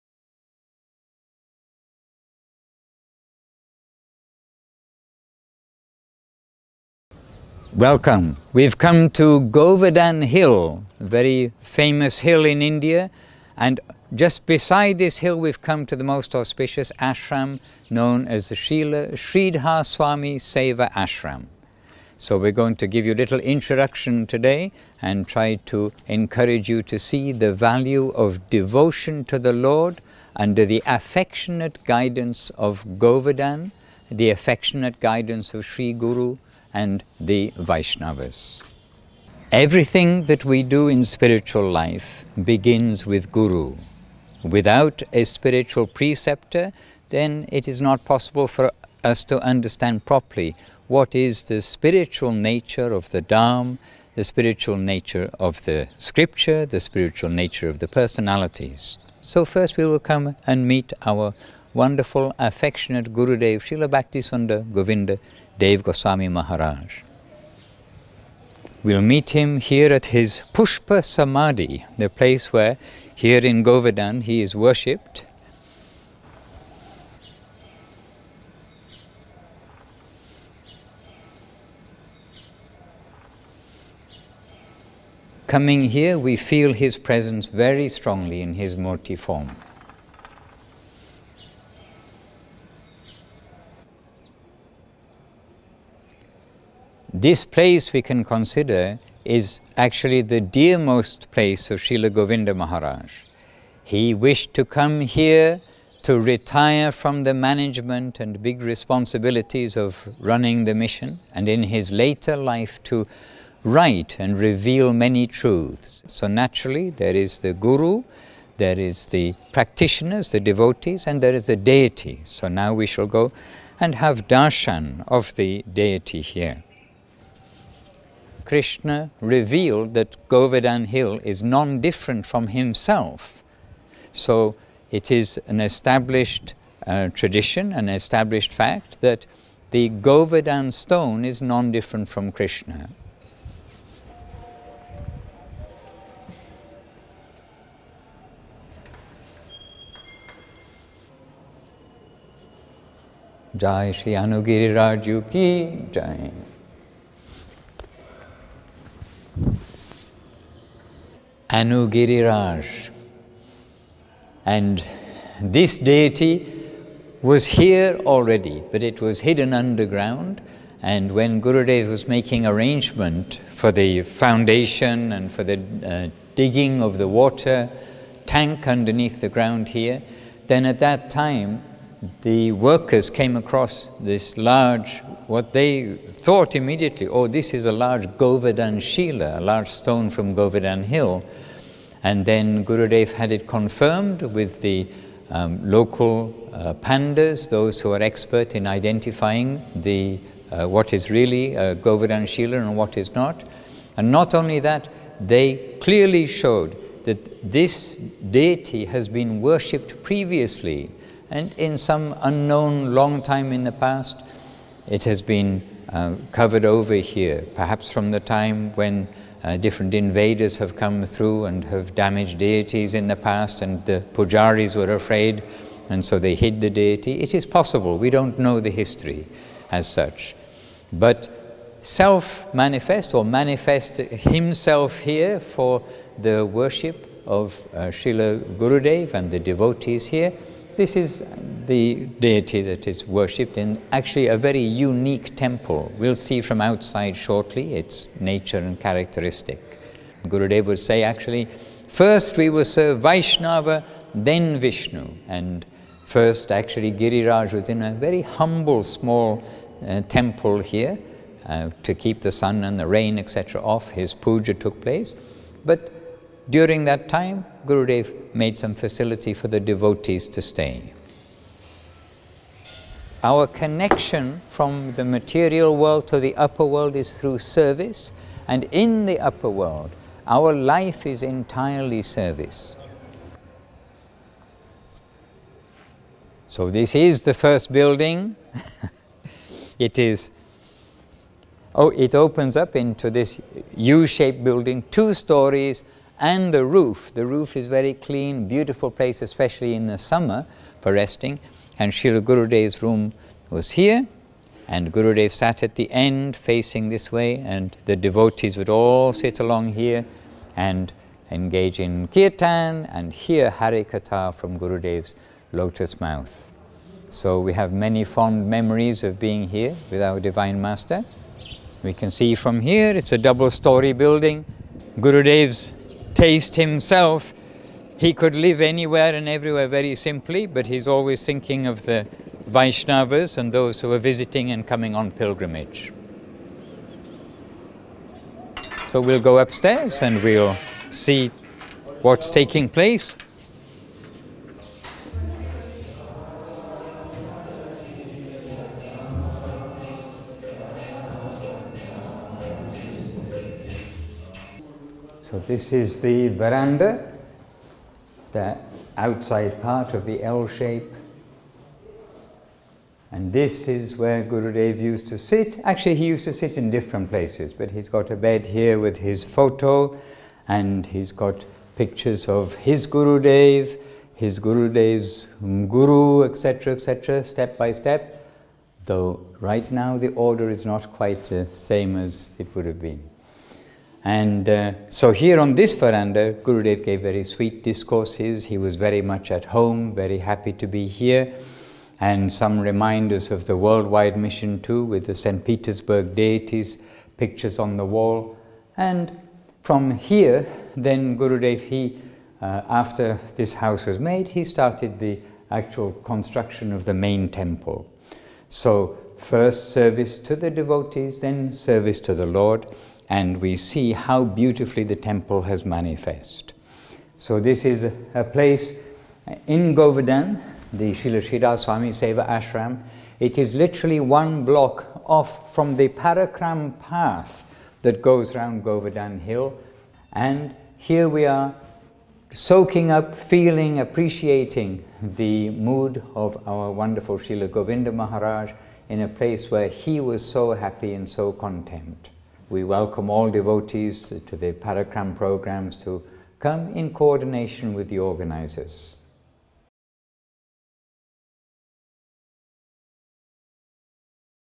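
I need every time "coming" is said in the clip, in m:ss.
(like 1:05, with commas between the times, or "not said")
1:25, 5:34.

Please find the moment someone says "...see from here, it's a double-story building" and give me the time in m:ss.
5:22.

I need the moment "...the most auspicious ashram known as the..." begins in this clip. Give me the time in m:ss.
0:15.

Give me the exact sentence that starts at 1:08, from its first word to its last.
We'll meet him here at his Pushpa Samadhi, the place where here in Govardhan he is worshipped.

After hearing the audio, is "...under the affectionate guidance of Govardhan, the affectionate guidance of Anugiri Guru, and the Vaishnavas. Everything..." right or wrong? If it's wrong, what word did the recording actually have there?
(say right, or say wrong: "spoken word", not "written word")
wrong: "Sri", not "Anugiri".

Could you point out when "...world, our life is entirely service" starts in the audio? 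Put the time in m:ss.
4:39.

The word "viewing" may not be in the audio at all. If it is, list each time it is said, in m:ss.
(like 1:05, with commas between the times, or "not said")
not said.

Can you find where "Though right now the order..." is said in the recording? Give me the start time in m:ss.
6:18.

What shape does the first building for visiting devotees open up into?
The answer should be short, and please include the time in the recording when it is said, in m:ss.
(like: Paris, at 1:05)
U-shaped, at 4:53.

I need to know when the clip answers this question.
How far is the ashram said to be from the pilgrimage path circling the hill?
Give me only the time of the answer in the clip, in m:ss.
7:04.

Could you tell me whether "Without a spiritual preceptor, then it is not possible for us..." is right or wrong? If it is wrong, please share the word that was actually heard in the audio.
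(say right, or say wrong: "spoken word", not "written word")
right.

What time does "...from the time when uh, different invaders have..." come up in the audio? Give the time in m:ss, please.
3:37.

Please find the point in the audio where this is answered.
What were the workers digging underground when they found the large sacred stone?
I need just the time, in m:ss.
2:57.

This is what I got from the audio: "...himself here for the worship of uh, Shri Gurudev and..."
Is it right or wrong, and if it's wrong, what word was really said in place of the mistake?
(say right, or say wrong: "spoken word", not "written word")
wrong: "Srila", not "Shri".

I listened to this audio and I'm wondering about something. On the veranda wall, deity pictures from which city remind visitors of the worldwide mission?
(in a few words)
St. Petersburg.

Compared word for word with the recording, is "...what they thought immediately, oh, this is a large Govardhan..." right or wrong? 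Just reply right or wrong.
right.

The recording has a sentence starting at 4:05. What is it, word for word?
We'll see from outside shortly its nature and characteristic.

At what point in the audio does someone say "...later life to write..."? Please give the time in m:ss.
1:51.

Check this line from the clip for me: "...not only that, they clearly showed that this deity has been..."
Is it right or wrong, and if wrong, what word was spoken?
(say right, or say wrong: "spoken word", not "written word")
right.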